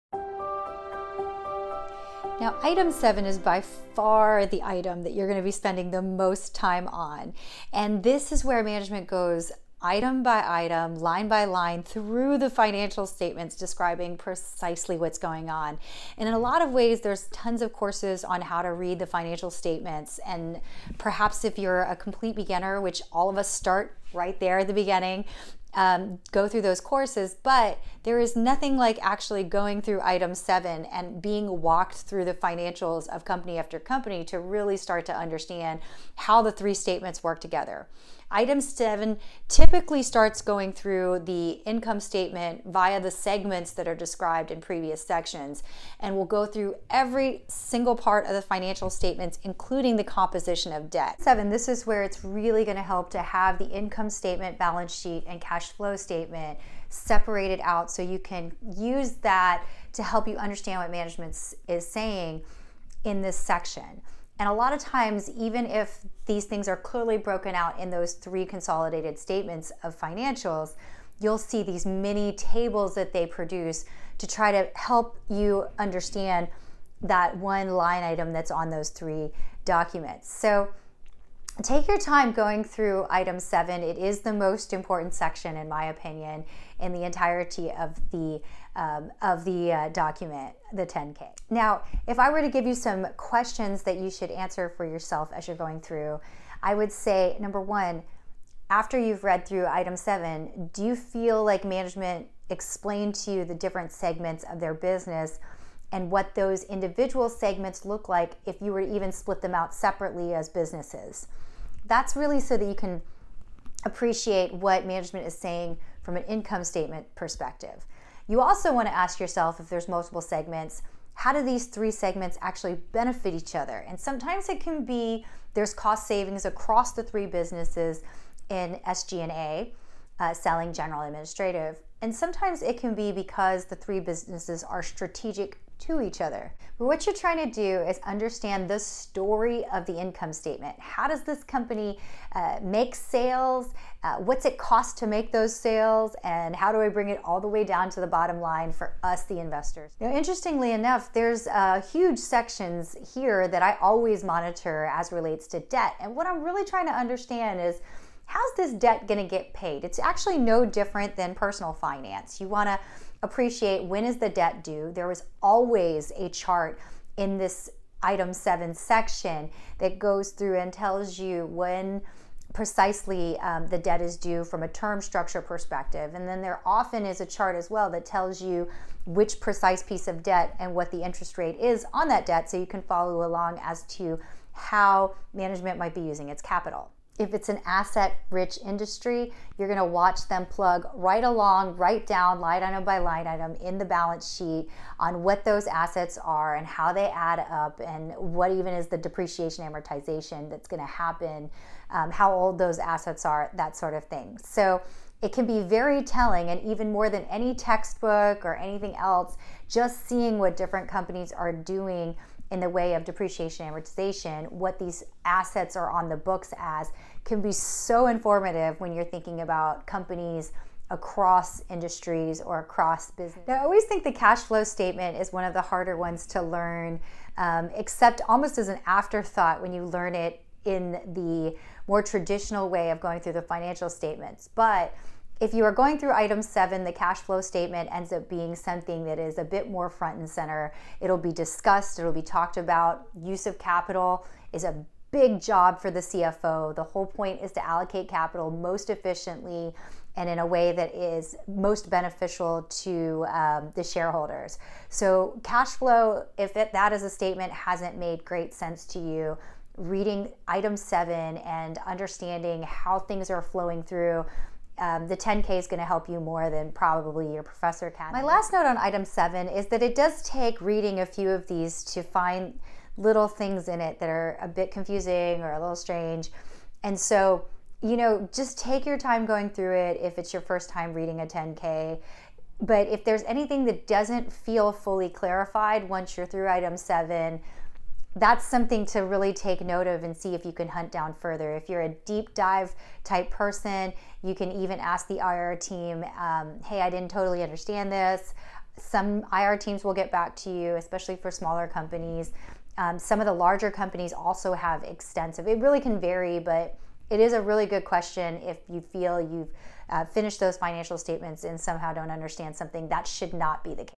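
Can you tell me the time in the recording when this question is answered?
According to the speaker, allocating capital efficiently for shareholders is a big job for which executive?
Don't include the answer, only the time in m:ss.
4:05.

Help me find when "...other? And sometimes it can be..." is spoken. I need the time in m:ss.
2:03.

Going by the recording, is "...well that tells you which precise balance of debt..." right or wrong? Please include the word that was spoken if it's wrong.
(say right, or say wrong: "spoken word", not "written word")
wrong: "piece", not "balance".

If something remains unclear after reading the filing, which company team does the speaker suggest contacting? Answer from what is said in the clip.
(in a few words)
IR team.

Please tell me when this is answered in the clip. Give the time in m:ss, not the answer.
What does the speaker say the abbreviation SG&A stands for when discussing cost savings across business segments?
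2:10.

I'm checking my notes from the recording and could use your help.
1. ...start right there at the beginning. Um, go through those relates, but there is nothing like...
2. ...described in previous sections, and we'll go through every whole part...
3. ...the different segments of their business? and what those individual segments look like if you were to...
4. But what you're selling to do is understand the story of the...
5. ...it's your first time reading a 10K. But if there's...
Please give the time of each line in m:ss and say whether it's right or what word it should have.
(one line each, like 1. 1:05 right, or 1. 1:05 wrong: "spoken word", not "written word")
1. 0:23 wrong: "courses", not "relates"
2. 0:43 wrong: "single", not "whole"
3. 1:43 right
4. 2:16 wrong: "trying", not "selling"
5. 4:40 right.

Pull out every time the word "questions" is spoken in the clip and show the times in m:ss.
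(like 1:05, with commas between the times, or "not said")
1:33, 5:07.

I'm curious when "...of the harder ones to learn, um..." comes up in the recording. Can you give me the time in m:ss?
3:45.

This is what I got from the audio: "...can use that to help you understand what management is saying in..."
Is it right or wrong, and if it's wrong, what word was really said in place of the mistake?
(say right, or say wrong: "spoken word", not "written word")
right.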